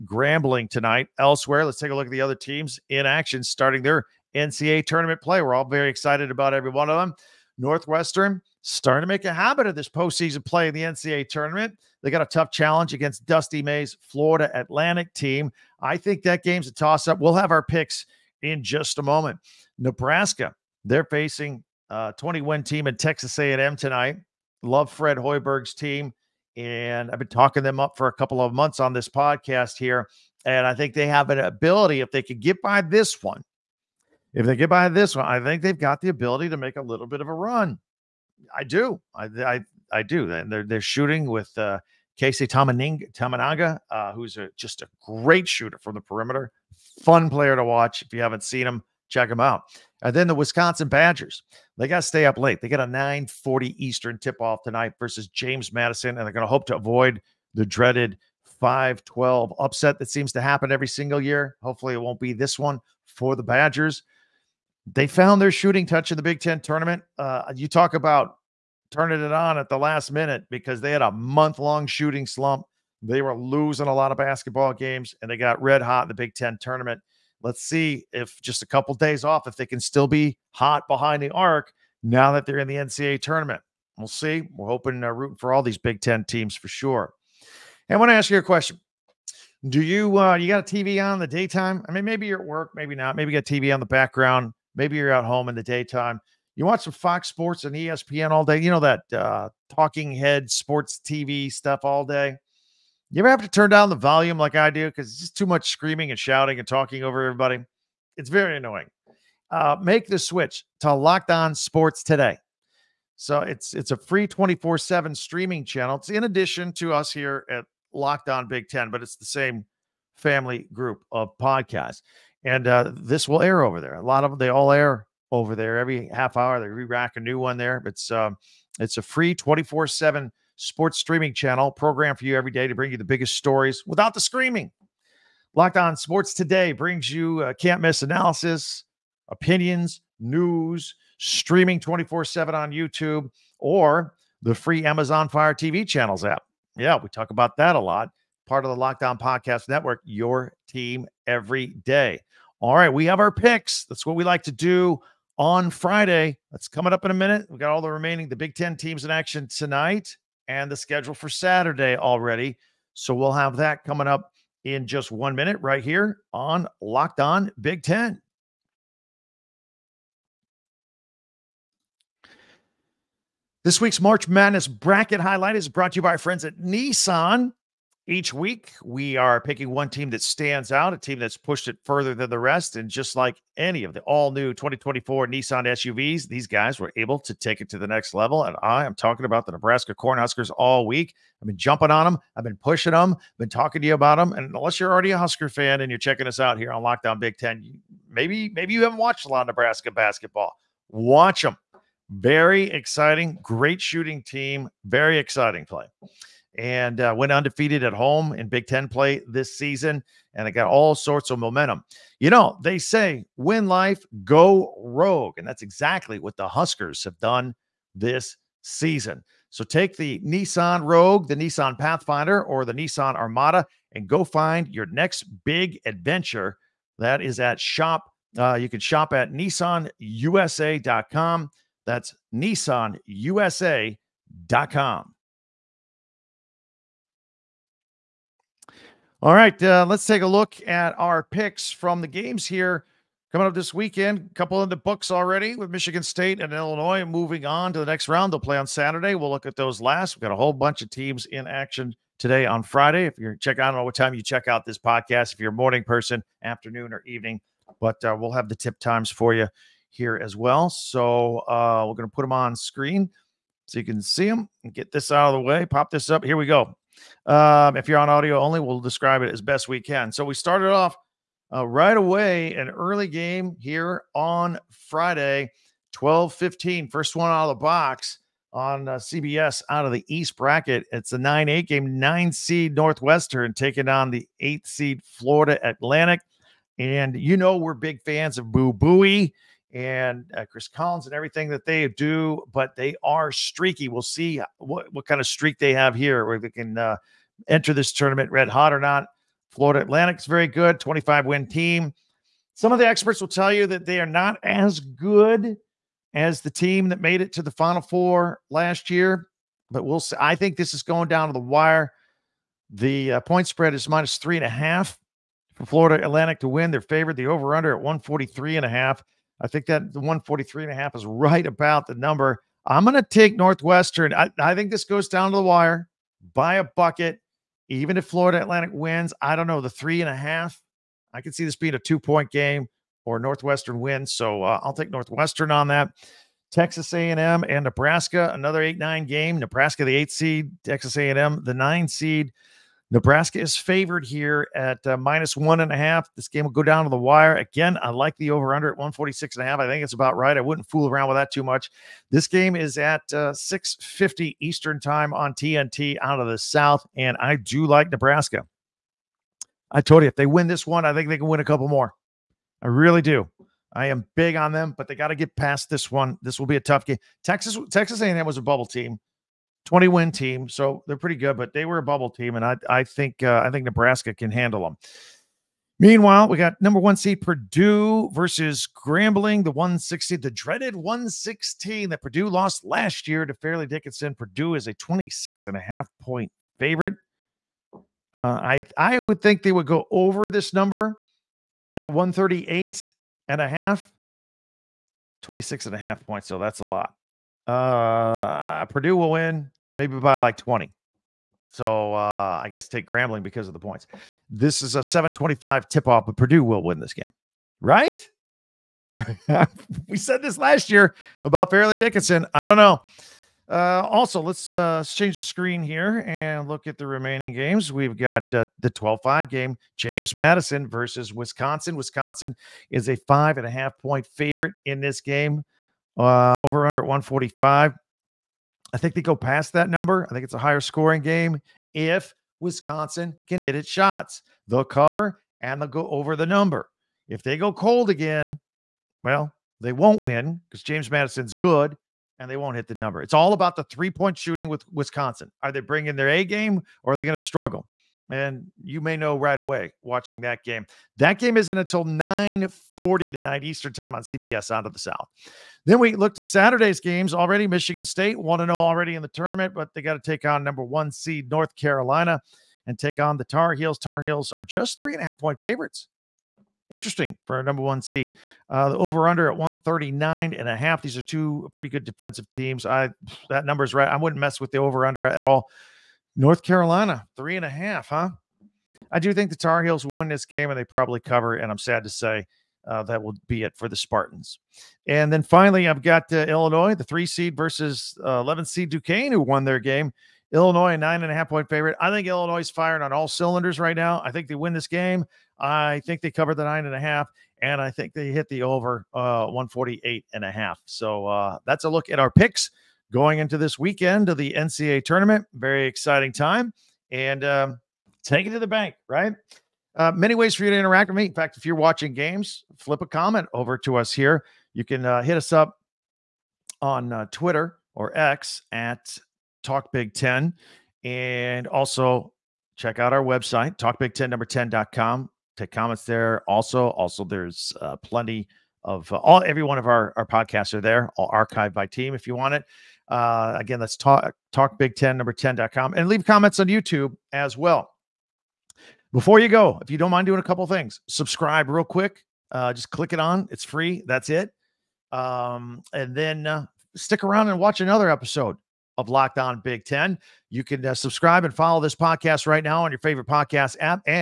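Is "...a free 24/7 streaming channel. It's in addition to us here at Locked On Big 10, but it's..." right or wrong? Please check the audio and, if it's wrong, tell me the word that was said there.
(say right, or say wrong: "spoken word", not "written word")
right.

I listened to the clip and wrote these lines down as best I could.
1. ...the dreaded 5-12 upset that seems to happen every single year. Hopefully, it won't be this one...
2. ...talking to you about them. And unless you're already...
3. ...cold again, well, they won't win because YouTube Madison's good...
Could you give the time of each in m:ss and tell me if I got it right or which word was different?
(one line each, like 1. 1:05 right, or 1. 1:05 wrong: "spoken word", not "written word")
1. 0:57 right
2. 3:13 right
3. 7:17 wrong: "James", not "YouTube".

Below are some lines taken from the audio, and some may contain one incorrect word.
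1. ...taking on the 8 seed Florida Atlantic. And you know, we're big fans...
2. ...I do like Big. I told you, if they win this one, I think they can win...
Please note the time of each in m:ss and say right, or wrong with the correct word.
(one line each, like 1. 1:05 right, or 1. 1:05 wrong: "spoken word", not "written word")
1. 4:43 right
2. 5:57 wrong: "Nebraska", not "Big".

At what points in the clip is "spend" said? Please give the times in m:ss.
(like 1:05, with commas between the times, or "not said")
not said.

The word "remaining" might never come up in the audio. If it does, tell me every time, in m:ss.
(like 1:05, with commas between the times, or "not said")
2:37, 6:56.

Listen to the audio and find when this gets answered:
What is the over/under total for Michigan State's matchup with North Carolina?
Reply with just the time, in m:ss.
7:49.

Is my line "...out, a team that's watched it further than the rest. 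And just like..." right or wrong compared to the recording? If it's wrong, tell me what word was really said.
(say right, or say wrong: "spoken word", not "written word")
wrong: "pushed", not "watched".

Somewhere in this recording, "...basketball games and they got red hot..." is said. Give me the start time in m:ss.
1:14.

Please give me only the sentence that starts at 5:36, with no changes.
Texas A&M and Nebraska, another eight nine game.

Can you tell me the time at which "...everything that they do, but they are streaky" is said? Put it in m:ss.
4:51.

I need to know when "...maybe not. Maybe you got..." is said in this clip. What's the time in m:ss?
1:32.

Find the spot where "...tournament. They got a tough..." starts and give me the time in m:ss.
0:11.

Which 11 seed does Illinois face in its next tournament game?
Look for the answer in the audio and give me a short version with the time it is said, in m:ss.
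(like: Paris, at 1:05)
Duquesne, at 8:08.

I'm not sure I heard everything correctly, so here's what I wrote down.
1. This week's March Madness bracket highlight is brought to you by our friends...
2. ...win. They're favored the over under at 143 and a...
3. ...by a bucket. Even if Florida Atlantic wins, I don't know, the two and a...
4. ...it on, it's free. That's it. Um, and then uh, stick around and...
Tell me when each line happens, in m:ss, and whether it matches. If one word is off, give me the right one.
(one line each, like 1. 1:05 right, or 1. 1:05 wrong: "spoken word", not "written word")
1. 2:53 right
2. 5:16 right
3. 5:26 wrong: "three", not "two"
4. 9:02 right.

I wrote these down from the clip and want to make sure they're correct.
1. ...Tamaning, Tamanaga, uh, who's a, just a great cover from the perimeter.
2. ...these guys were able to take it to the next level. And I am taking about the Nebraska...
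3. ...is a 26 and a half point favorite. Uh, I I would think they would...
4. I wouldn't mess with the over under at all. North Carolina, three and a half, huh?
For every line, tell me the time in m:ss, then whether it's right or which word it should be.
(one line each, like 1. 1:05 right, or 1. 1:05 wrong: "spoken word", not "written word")
1. 0:42 wrong: "shooter", not "cover"
2. 3:06 wrong: "talking", not "taking"
3. 6:24 right
4. 7:53 right.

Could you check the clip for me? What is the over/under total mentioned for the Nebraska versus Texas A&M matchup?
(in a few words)
146.5.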